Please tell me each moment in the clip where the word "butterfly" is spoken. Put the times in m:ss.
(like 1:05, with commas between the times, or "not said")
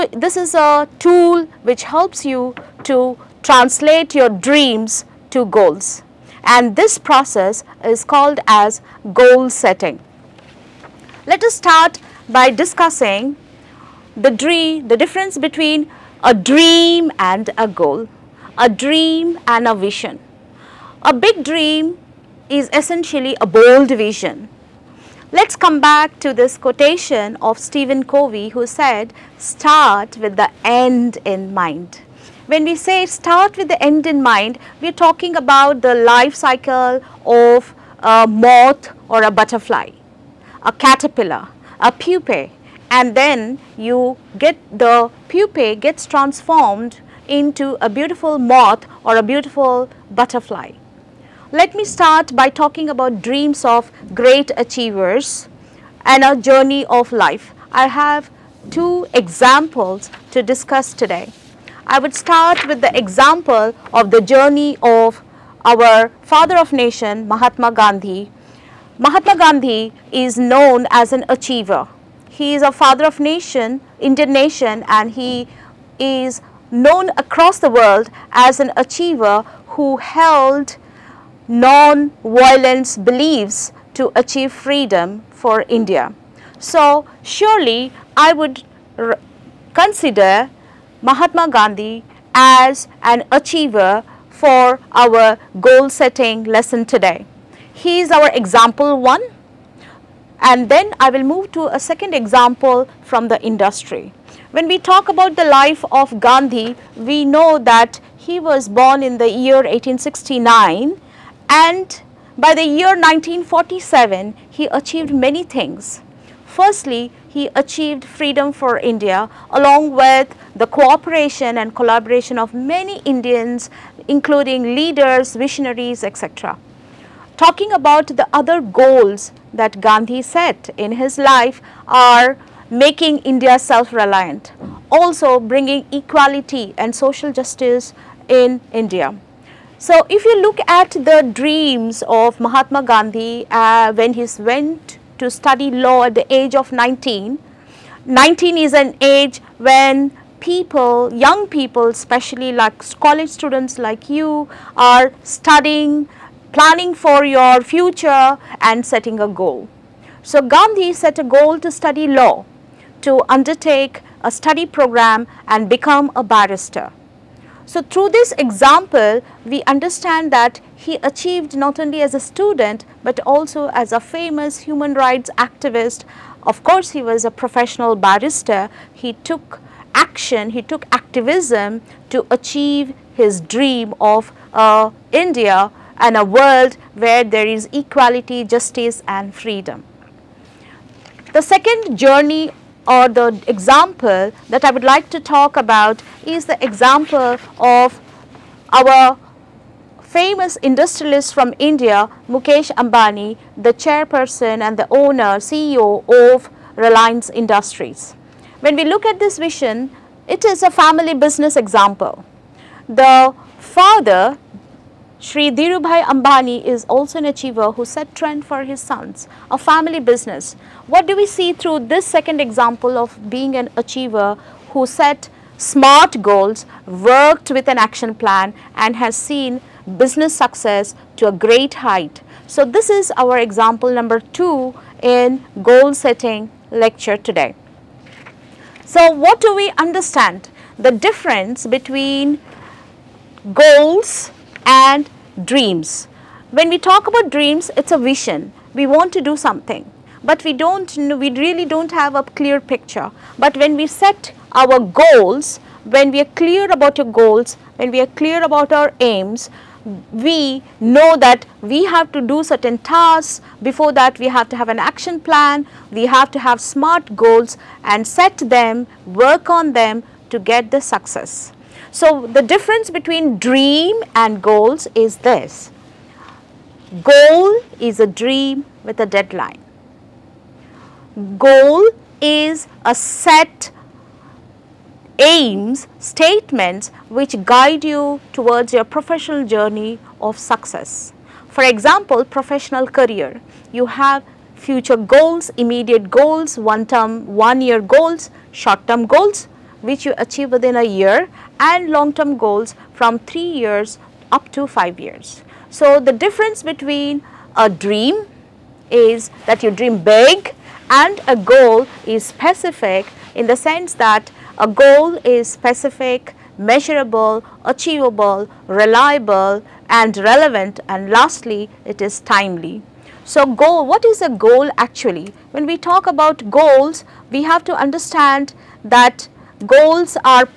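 0:39, 0:50.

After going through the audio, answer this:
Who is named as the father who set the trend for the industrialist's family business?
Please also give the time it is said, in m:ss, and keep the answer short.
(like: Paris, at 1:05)
Dhirubhai Ambani, at 3:35.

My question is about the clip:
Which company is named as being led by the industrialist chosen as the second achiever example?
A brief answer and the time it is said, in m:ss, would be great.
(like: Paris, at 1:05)
Reliance Industries, at 3:26.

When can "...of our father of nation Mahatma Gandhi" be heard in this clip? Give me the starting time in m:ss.
1:04.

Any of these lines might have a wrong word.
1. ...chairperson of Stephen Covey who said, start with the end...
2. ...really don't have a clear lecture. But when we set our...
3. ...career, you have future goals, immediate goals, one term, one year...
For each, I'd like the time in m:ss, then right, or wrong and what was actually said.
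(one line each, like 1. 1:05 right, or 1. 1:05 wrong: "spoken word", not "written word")
1. 0:26 wrong: "quotation", not "chairperson"
2. 4:11 wrong: "picture", not "lecture"
3. 4:52 right.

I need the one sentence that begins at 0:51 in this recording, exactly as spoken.
Let me start by talking about dreams of great achievers and a journey of life.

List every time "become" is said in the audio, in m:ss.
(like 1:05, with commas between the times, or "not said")
2:45.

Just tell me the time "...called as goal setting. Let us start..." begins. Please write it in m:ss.
0:08.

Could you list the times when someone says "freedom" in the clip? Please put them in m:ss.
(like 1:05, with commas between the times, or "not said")
1:24, 1:58, 3:09.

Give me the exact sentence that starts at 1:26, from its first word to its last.
So surely I would consider Mahatma Gandhi as an achiever for our goal setting lesson today.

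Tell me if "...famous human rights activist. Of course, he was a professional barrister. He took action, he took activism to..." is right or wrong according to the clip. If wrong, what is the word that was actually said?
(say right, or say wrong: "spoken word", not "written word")
right.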